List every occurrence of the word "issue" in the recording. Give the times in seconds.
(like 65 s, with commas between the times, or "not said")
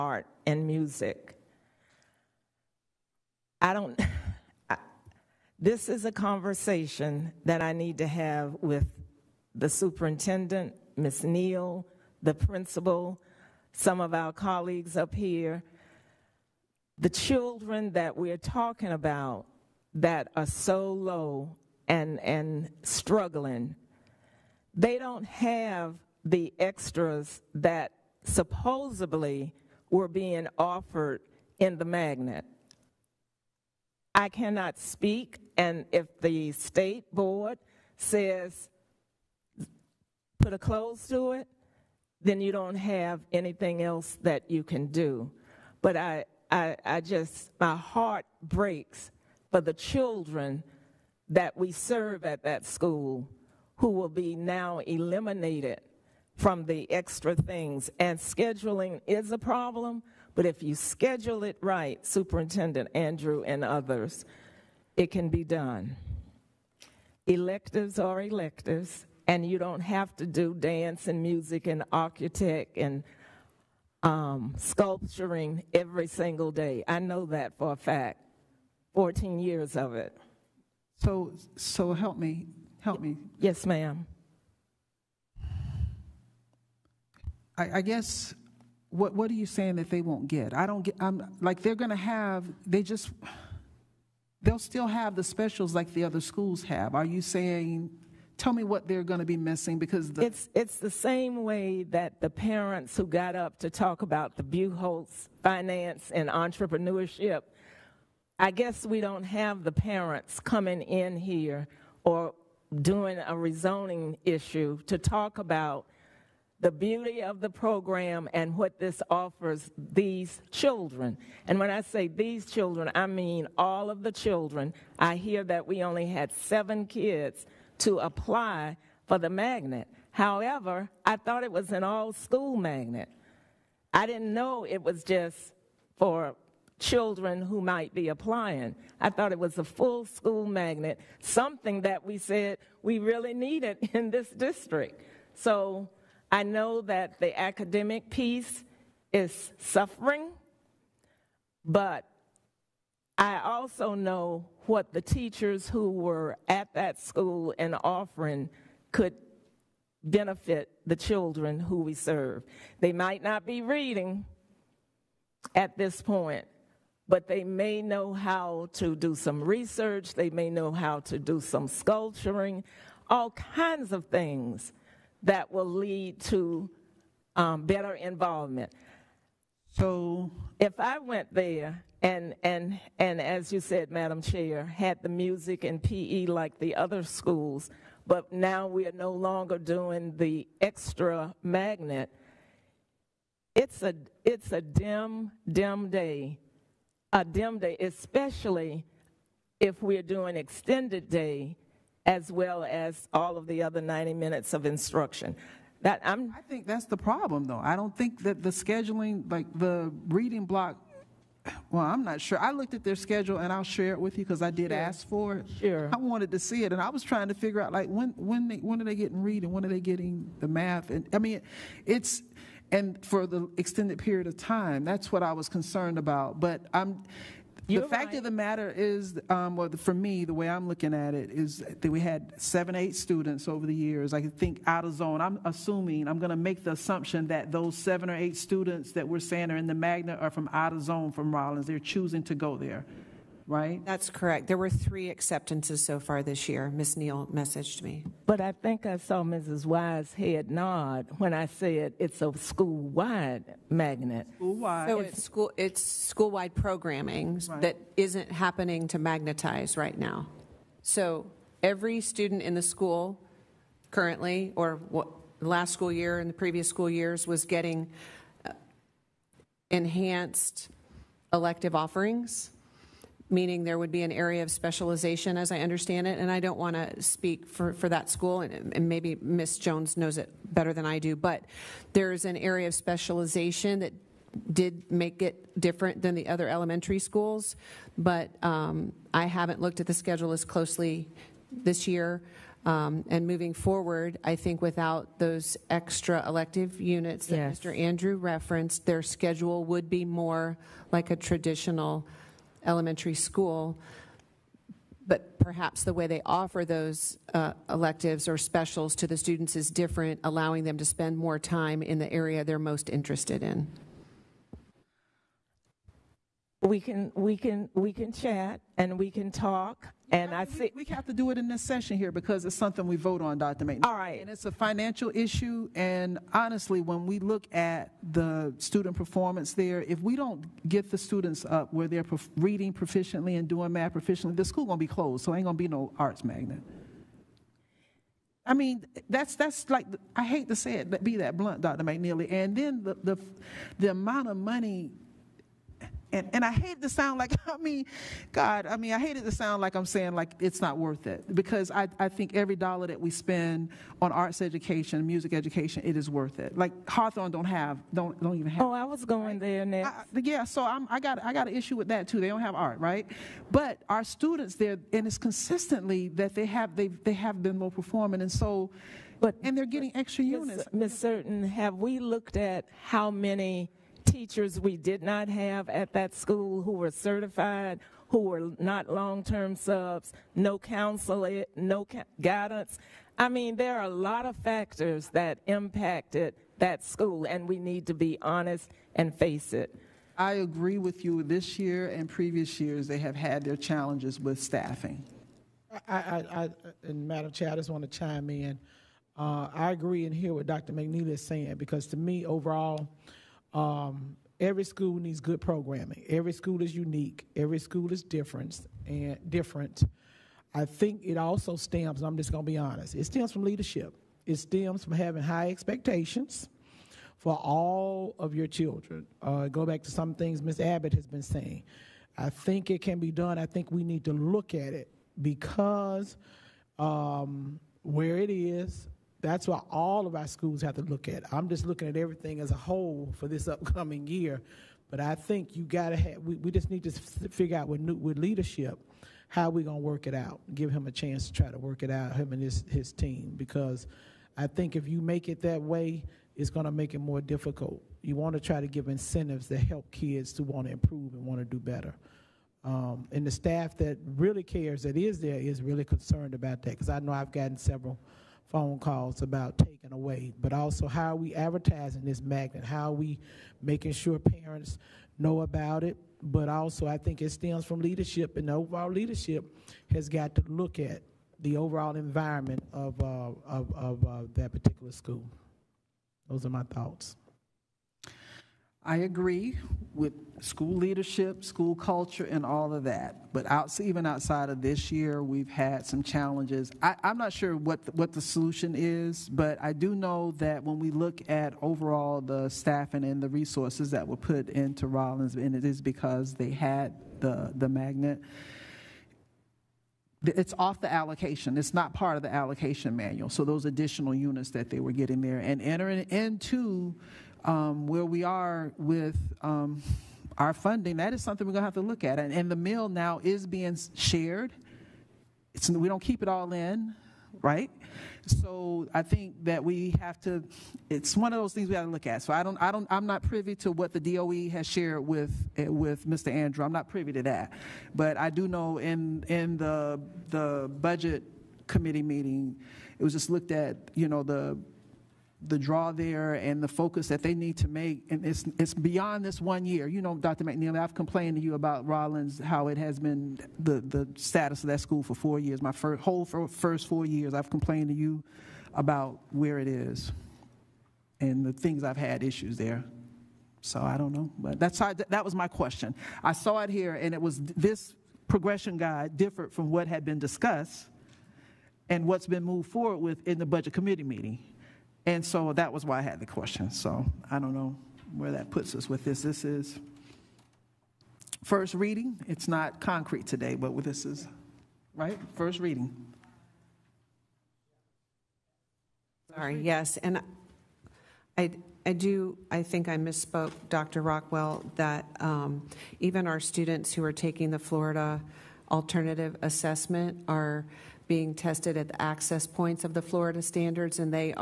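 114 s, 325 s, 361 s, 552 s.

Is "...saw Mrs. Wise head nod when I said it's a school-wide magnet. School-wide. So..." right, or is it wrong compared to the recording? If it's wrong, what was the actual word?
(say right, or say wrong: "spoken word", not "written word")
right.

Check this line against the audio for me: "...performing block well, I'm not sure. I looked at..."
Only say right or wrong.
wrong.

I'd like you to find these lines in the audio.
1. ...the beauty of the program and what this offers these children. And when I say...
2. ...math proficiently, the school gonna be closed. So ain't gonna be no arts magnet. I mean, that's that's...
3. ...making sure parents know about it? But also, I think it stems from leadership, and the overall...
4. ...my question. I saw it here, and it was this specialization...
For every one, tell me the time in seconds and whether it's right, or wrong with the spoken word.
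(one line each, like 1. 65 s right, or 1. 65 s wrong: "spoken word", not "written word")
1. 116 s right
2. 333 s right
3. 463 s right
4. 555 s wrong: "progression", not "specialization".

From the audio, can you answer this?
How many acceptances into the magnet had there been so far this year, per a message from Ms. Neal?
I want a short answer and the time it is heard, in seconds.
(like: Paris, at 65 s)
3, at 244 s.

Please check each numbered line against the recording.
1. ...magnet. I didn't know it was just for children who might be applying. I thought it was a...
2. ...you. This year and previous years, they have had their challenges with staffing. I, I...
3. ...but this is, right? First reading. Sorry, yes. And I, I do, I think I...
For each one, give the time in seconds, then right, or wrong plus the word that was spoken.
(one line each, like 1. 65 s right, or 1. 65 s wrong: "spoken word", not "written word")
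1. 132 s right
2. 391 s right
3. 573 s right.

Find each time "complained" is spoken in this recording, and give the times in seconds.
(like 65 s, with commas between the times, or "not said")
540 s, 547 s.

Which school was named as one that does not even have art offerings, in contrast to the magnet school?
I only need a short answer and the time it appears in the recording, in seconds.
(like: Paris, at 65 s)
Hawthorne, at 356 s.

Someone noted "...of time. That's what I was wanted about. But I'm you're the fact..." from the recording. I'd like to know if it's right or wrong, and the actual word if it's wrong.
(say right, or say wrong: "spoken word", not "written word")
wrong: "concerned", not "wanted".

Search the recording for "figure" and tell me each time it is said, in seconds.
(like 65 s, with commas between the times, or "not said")
217 s, 437 s.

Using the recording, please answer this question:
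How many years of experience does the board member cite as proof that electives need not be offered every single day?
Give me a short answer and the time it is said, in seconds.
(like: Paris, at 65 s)
14 years, at 78 s.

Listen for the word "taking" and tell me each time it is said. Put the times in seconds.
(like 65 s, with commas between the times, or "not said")
459 s, 587 s.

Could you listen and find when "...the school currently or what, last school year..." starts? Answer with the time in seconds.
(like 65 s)
262 s.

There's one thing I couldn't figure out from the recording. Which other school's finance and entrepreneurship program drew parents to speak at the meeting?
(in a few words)
Buchholz.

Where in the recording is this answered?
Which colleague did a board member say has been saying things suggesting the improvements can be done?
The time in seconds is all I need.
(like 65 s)
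420 s.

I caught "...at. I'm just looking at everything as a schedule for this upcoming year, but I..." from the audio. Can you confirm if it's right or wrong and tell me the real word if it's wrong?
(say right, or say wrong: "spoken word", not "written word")
wrong: "whole", not "schedule".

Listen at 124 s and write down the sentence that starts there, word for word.
I hear that we only had seven kids to apply for the magnet.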